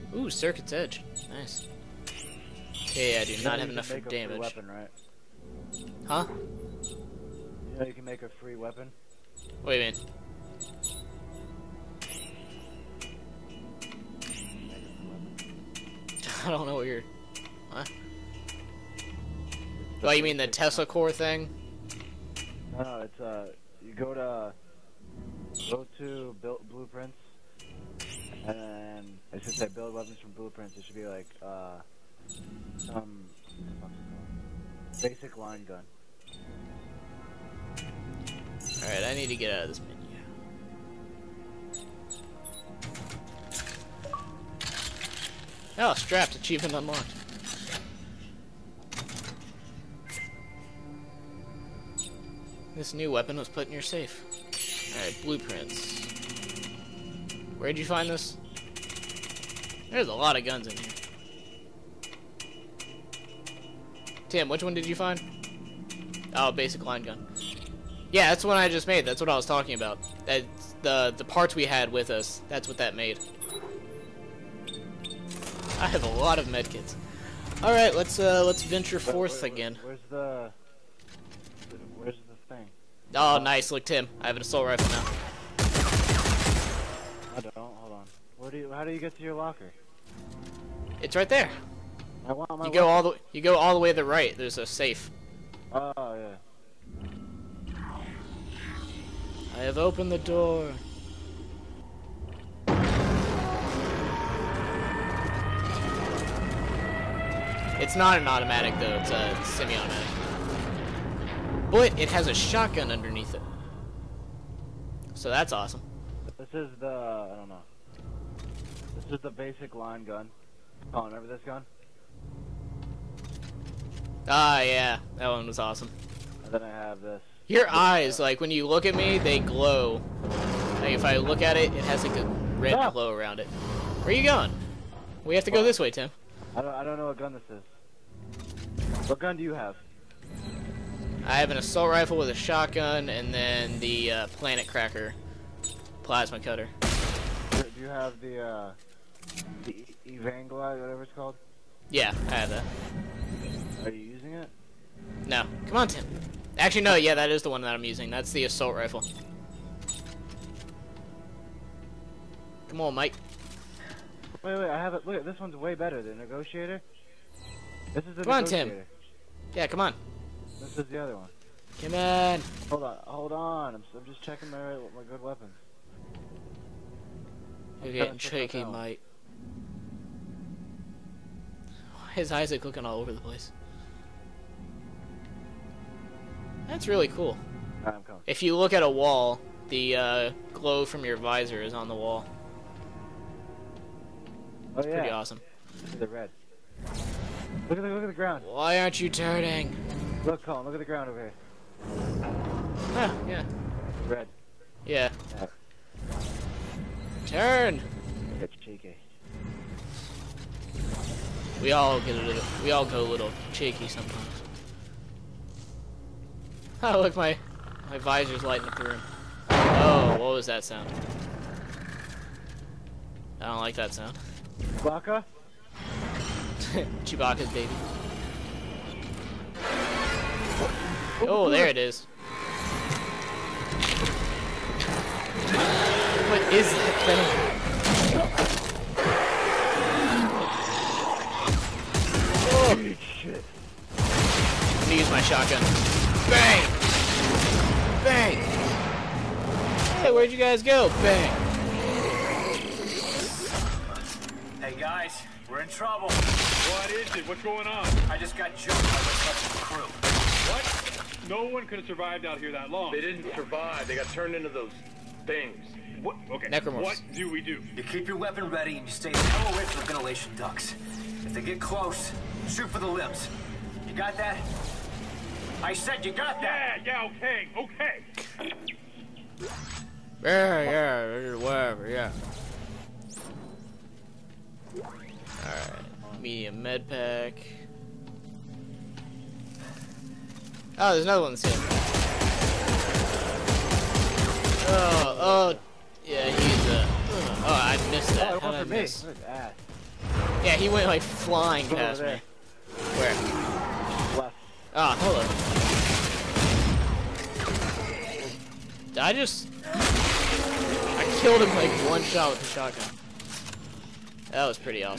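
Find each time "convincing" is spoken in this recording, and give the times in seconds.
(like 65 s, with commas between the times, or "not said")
not said.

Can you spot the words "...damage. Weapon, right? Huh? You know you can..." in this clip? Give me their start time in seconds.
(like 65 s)
4 s.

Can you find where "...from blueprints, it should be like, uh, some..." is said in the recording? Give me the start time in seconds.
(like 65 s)
30 s.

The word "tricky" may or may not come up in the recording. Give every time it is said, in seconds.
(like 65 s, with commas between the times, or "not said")
178 s.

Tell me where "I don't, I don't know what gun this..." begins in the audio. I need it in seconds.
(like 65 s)
136 s.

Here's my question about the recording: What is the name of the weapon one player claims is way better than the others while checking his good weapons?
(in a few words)
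The Negotiator.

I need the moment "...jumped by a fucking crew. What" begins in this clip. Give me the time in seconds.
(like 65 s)
258 s.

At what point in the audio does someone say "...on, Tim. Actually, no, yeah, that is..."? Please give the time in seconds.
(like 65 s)
155 s.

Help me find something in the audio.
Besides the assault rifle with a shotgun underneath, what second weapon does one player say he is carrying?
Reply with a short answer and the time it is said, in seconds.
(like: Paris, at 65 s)
planet cracker plasma cutter, at 144 s.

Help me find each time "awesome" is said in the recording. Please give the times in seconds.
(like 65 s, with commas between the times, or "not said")
115 s, 125 s, 195 s.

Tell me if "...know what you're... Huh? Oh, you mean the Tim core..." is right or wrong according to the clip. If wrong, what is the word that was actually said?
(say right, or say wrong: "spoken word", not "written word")
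wrong: "Tesla", not "Tim".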